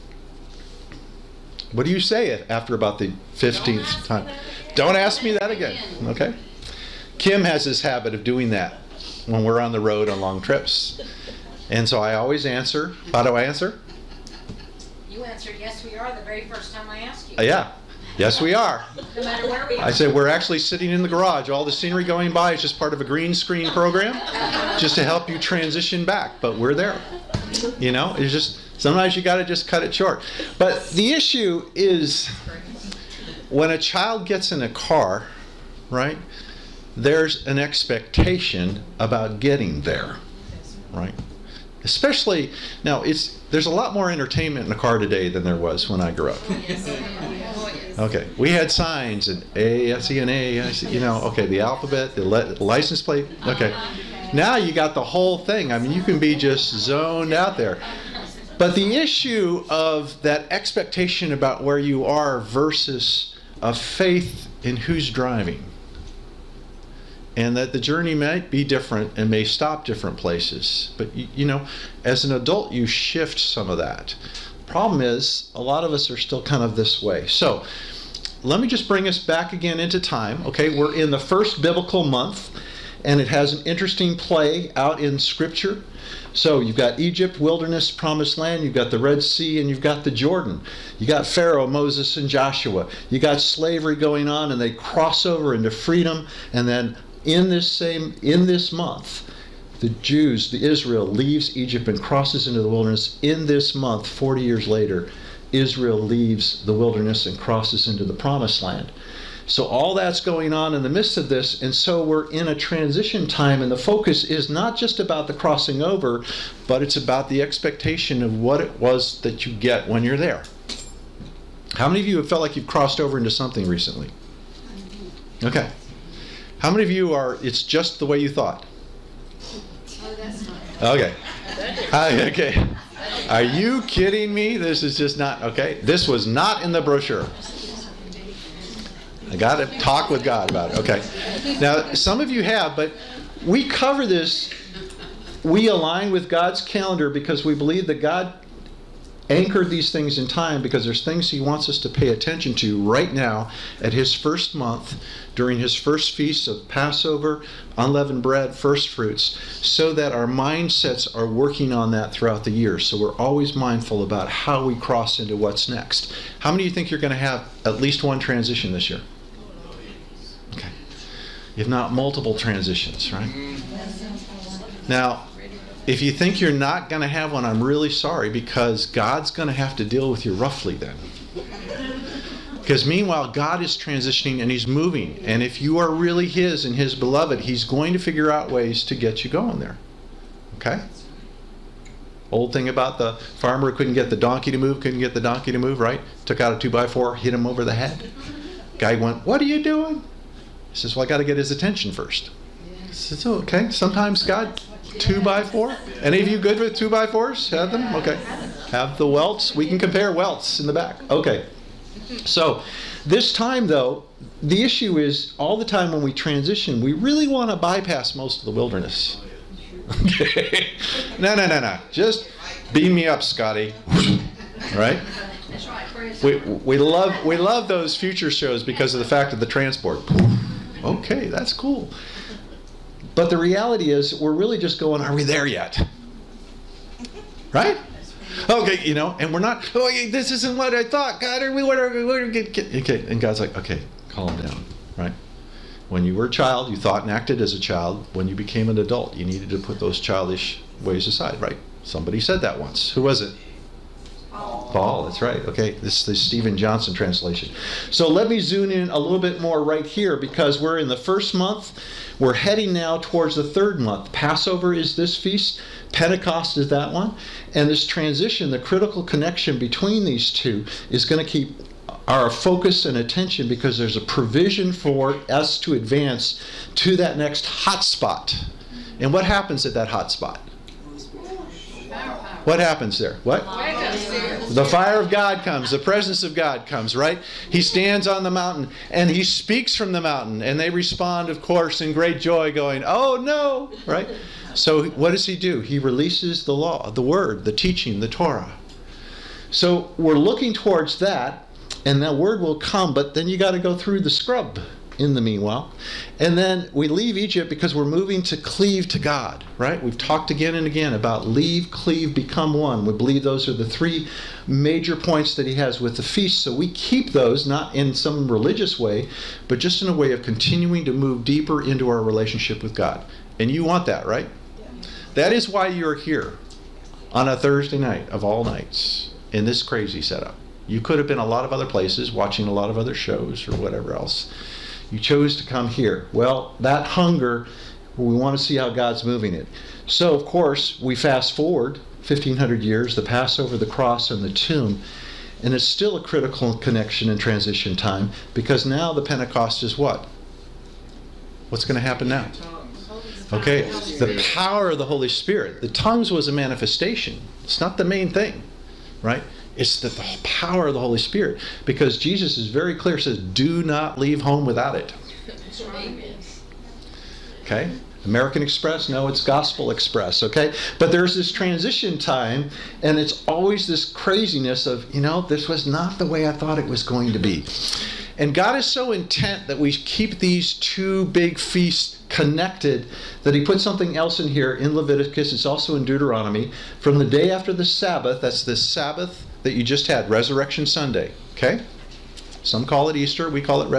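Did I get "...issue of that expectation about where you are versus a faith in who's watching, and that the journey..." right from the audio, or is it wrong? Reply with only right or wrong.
wrong.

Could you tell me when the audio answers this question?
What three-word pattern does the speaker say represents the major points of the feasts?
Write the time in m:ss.
5:11.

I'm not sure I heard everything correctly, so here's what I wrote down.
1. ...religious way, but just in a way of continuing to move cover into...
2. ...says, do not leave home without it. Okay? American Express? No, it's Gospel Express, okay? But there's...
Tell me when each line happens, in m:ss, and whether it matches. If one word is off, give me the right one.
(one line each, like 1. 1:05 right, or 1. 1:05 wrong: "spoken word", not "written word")
1. 5:18 wrong: "deeper", not "cover"
2. 6:02 right.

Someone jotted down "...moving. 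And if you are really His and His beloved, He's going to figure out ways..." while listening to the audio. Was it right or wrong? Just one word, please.
right.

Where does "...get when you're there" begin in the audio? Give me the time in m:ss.
1:59.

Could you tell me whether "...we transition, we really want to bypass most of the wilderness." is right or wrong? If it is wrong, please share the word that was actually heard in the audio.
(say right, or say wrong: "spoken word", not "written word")
right.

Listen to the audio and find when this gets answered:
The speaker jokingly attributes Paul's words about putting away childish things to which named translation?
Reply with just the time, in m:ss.
4:16.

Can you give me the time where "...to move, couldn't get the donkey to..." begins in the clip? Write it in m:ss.
3:14.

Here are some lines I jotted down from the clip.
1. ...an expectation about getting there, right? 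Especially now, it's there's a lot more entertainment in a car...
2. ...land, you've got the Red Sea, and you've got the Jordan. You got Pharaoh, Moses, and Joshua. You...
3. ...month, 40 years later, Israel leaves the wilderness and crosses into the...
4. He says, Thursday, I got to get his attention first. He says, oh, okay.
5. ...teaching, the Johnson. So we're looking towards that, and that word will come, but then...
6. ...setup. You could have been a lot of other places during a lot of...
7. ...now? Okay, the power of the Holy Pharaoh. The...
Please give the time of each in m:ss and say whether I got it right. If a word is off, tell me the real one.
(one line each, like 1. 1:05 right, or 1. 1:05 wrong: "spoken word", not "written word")
1. 0:37 right
2. 1:28 right
3. 1:43 right
4. 3:20 wrong: "Well", not "Thursday"
5. 4:57 wrong: "Torah", not "Johnson"
6. 5:30 wrong: "watching", not "during"
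7. 5:52 wrong: "Spirit", not "Pharaoh".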